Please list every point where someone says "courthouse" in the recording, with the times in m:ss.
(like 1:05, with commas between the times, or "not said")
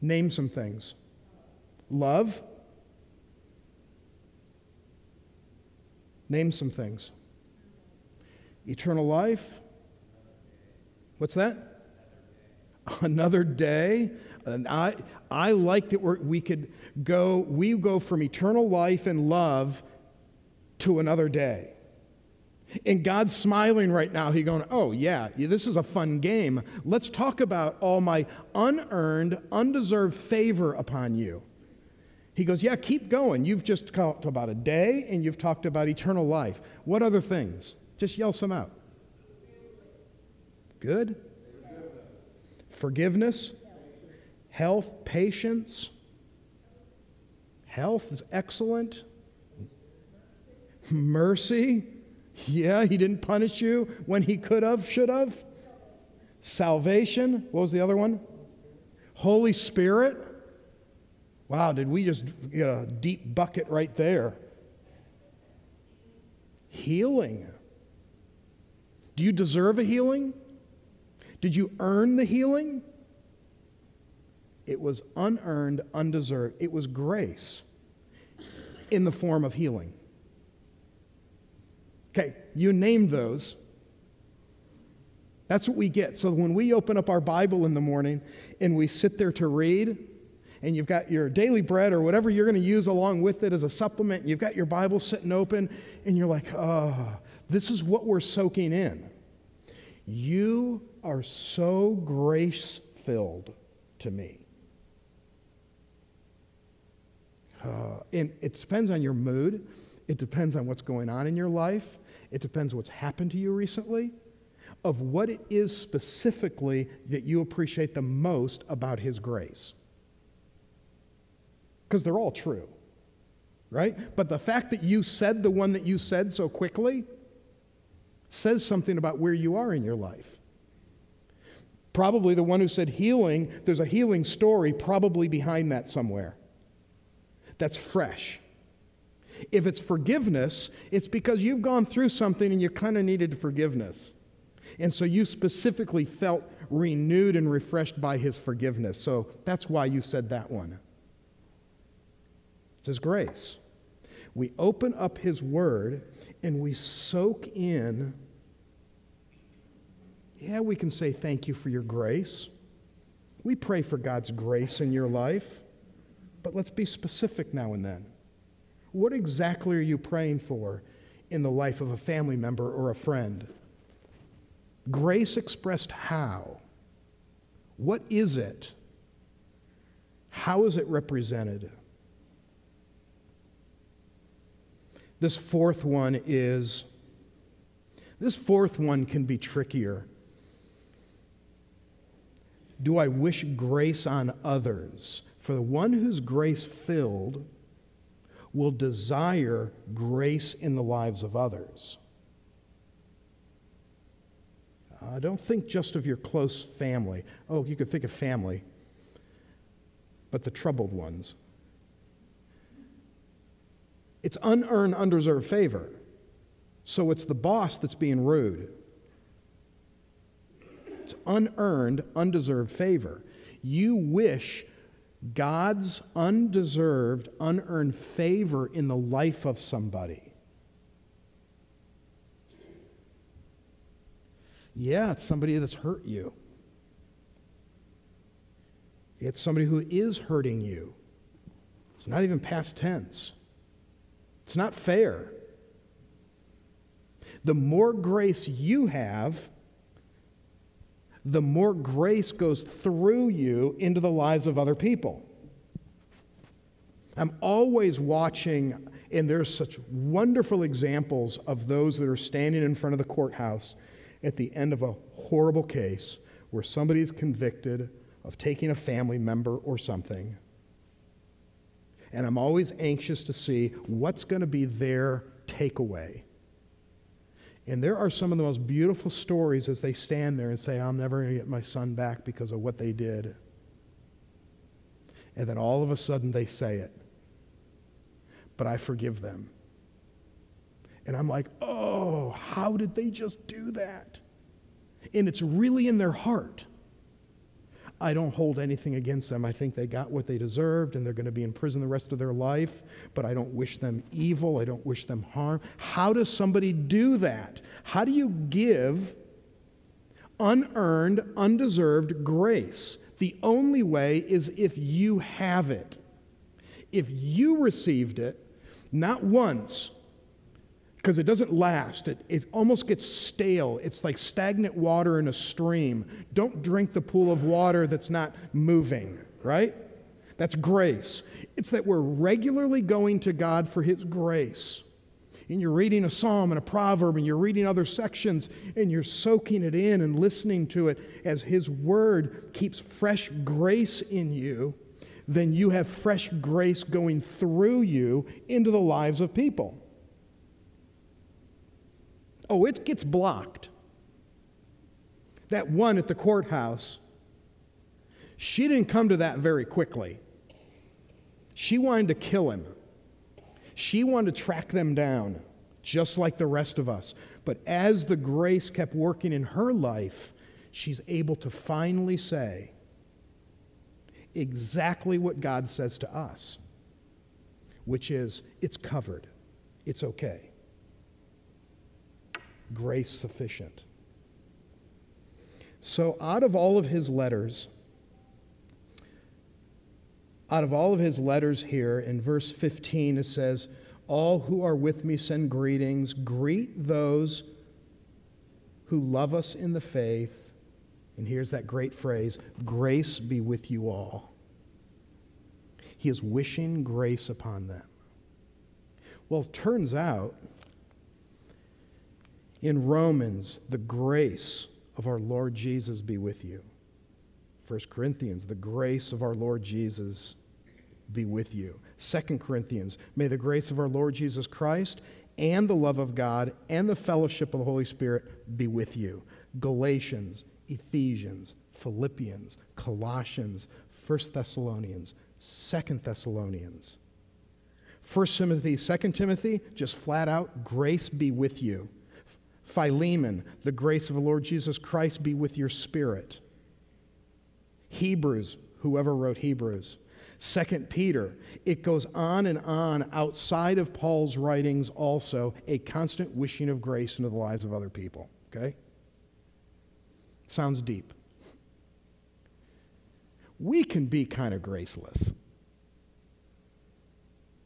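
4:23, 5:56.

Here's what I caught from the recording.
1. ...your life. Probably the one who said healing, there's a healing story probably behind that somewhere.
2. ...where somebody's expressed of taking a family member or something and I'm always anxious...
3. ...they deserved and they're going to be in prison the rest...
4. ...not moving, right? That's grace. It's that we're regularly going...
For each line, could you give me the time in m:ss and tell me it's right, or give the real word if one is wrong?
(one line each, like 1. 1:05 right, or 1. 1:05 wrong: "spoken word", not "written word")
1. 2:09 right
2. 4:26 wrong: "convicted", not "expressed"
3. 5:00 right
4. 5:28 right.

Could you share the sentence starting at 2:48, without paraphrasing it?
What exactly are you praying for in the life of a family member or a friend?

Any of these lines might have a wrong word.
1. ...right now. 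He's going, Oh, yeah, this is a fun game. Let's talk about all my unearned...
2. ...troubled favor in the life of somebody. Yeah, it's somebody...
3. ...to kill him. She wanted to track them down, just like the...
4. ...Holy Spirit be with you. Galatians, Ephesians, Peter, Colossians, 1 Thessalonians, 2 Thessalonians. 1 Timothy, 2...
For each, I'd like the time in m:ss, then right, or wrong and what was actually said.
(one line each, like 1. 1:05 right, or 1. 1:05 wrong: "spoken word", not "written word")
1. 0:23 right
2. 3:47 wrong: "unearned", not "troubled"
3. 6:02 right
4. 7:07 wrong: "Philippians", not "Peter".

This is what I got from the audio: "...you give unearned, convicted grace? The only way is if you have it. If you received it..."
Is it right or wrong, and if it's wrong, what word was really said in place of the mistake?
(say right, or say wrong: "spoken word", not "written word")
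wrong: "undeserved", not "convicted".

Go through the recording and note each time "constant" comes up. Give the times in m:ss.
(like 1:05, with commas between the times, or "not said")
7:35.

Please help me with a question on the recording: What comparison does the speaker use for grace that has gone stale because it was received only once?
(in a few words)
Stagnant water.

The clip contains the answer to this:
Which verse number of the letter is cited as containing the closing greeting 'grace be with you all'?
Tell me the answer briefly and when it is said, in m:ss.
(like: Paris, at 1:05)
15, at 6:32.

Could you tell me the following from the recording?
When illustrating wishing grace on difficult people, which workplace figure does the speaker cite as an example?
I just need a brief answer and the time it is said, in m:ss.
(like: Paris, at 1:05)
The boss, at 3:37.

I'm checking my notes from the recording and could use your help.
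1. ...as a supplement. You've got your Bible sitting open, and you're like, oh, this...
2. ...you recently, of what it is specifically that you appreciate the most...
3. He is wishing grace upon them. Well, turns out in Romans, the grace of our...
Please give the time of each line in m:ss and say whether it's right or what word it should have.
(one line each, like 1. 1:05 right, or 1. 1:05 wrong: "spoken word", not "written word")
1. 1:33 right
2. 1:53 right
3. 6:45 right.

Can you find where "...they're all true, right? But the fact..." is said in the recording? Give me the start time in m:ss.
2:02.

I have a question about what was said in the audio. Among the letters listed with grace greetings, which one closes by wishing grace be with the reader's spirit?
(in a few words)
Philemon.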